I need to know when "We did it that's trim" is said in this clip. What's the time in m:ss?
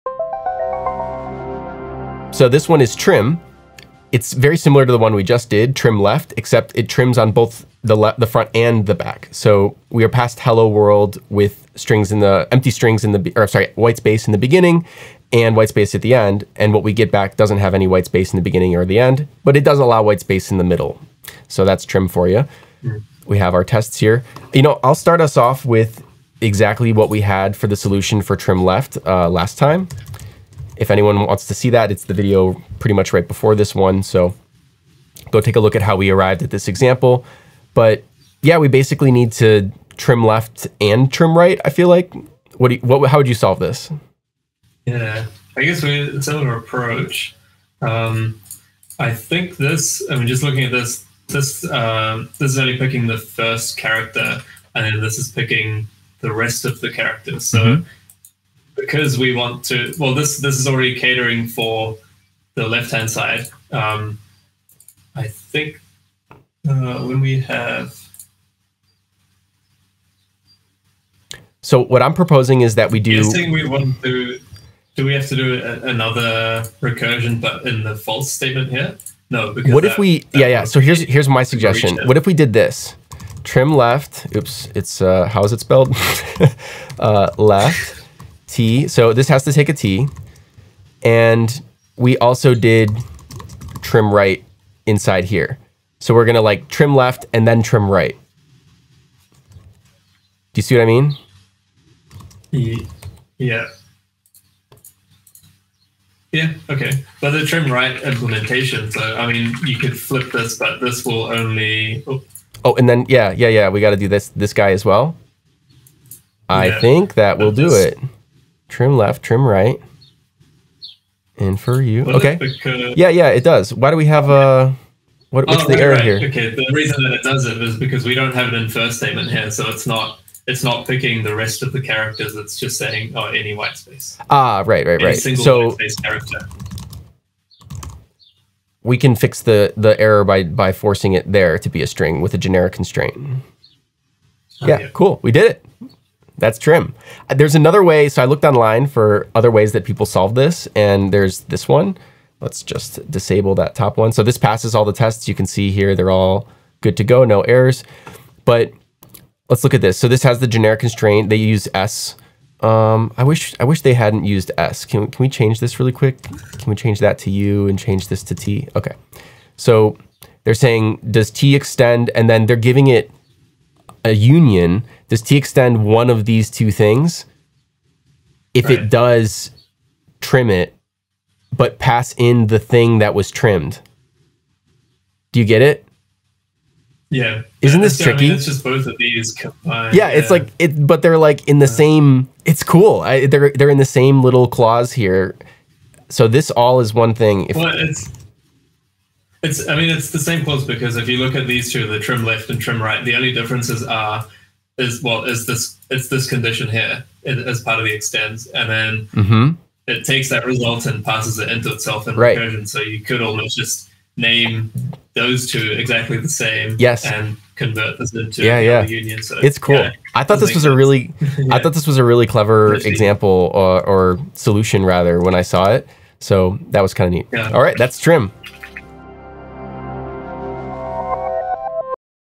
2:25.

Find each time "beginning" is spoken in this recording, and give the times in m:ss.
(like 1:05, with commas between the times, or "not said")
0:14, 0:18.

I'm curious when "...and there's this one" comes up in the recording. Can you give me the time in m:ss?
2:30.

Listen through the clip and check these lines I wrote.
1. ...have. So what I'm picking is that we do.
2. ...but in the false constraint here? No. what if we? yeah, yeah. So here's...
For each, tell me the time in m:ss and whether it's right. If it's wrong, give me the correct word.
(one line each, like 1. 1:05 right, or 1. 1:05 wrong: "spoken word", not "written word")
1. 1:07 wrong: "proposing", not "picking"
2. 1:17 wrong: "statement", not "constraint".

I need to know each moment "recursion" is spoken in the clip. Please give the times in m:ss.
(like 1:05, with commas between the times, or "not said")
1:16, 3:32.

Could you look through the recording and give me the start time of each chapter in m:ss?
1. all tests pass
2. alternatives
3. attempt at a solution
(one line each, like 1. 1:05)
1. 2:16
2. 2:31
3. 0:43.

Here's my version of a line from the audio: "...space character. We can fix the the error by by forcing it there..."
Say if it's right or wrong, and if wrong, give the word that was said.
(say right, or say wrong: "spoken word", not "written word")
right.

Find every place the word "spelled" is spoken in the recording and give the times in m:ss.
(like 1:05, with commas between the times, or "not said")
1:25.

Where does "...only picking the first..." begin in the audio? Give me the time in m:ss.
0:52.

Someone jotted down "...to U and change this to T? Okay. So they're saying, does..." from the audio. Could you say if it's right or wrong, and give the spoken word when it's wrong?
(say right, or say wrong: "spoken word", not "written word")
right.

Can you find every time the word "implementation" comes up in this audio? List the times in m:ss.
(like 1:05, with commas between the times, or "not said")
1:48.